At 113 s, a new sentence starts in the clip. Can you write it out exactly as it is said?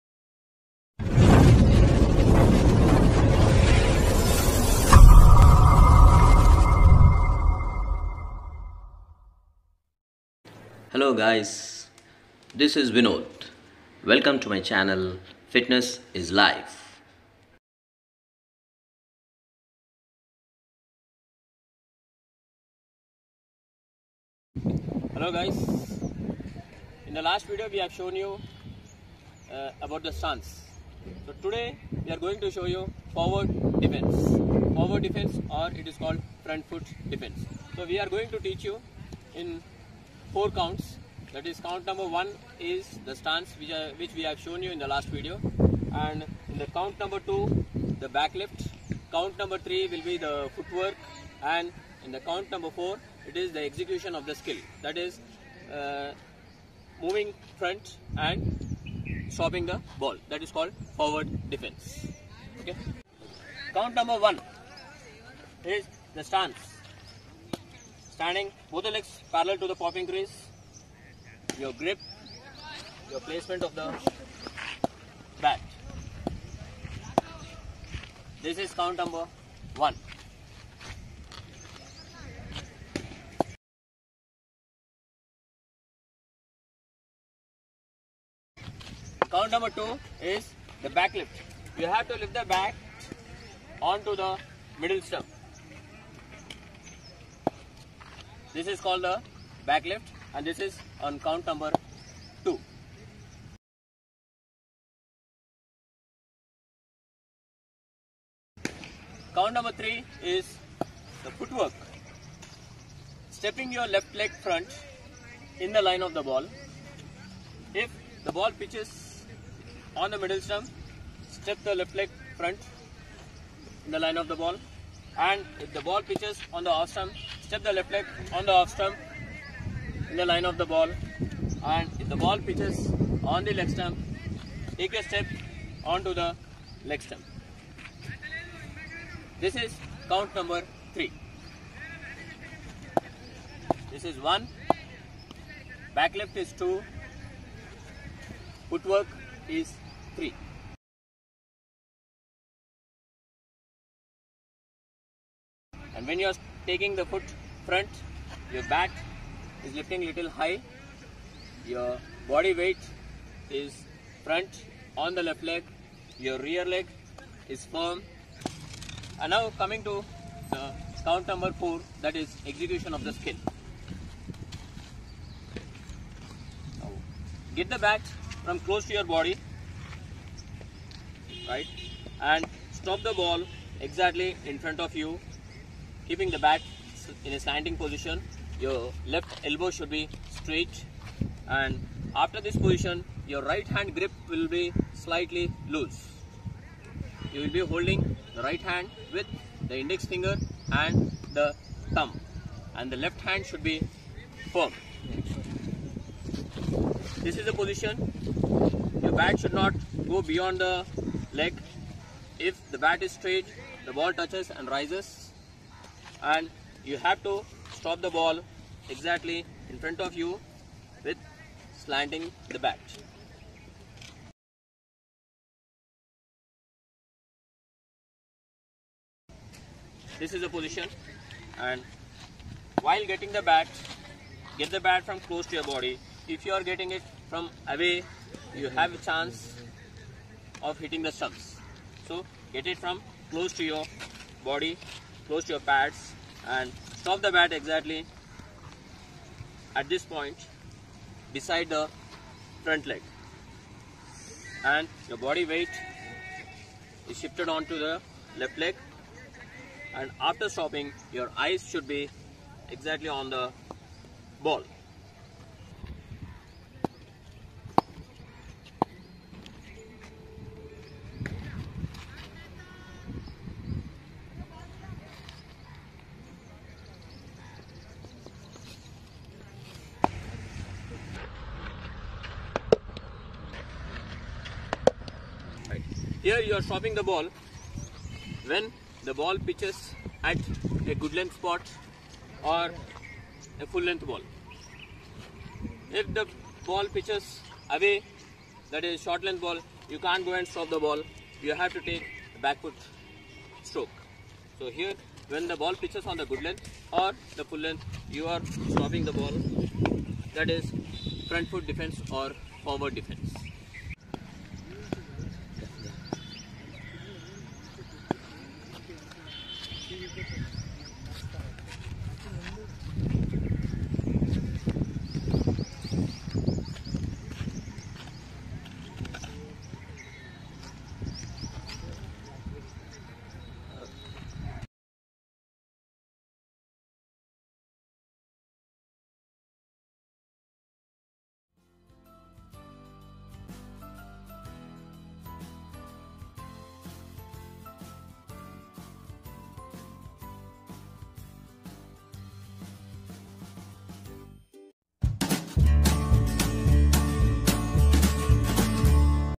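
Stepping your left leg front in the line of the ball.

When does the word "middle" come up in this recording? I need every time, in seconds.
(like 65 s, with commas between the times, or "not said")
94 s, 120 s.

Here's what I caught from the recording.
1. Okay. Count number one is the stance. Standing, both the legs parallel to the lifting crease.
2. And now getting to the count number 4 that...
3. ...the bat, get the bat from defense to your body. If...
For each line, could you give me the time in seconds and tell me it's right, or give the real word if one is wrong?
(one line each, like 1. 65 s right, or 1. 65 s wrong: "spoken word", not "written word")
1. 62 s wrong: "popping", not "lifting"
2. 169 s wrong: "coming", not "getting"
3. 233 s wrong: "close", not "defense".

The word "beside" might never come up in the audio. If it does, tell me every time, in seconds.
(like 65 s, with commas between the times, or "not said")
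251 s.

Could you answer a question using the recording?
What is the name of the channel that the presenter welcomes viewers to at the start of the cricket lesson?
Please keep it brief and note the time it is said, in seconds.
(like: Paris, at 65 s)
Fitness is Life, at 15 s.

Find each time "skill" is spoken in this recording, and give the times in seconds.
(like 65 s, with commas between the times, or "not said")
54 s, 173 s.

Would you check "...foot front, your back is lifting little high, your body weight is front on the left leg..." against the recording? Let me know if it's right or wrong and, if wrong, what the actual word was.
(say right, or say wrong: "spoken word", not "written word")
right.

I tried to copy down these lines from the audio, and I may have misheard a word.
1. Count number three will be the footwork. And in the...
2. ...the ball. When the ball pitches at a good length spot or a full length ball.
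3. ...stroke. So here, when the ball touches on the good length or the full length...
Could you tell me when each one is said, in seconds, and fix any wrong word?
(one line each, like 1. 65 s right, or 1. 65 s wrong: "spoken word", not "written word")
1. 49 s right
2. 286 s right
3. 303 s wrong: "pitches", not "touches".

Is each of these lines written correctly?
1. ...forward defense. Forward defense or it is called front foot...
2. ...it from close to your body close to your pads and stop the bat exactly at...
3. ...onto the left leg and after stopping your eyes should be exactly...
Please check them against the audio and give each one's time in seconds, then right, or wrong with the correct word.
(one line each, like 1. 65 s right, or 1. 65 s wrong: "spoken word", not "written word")
1. 33 s right
2. 242 s right
3. 257 s right.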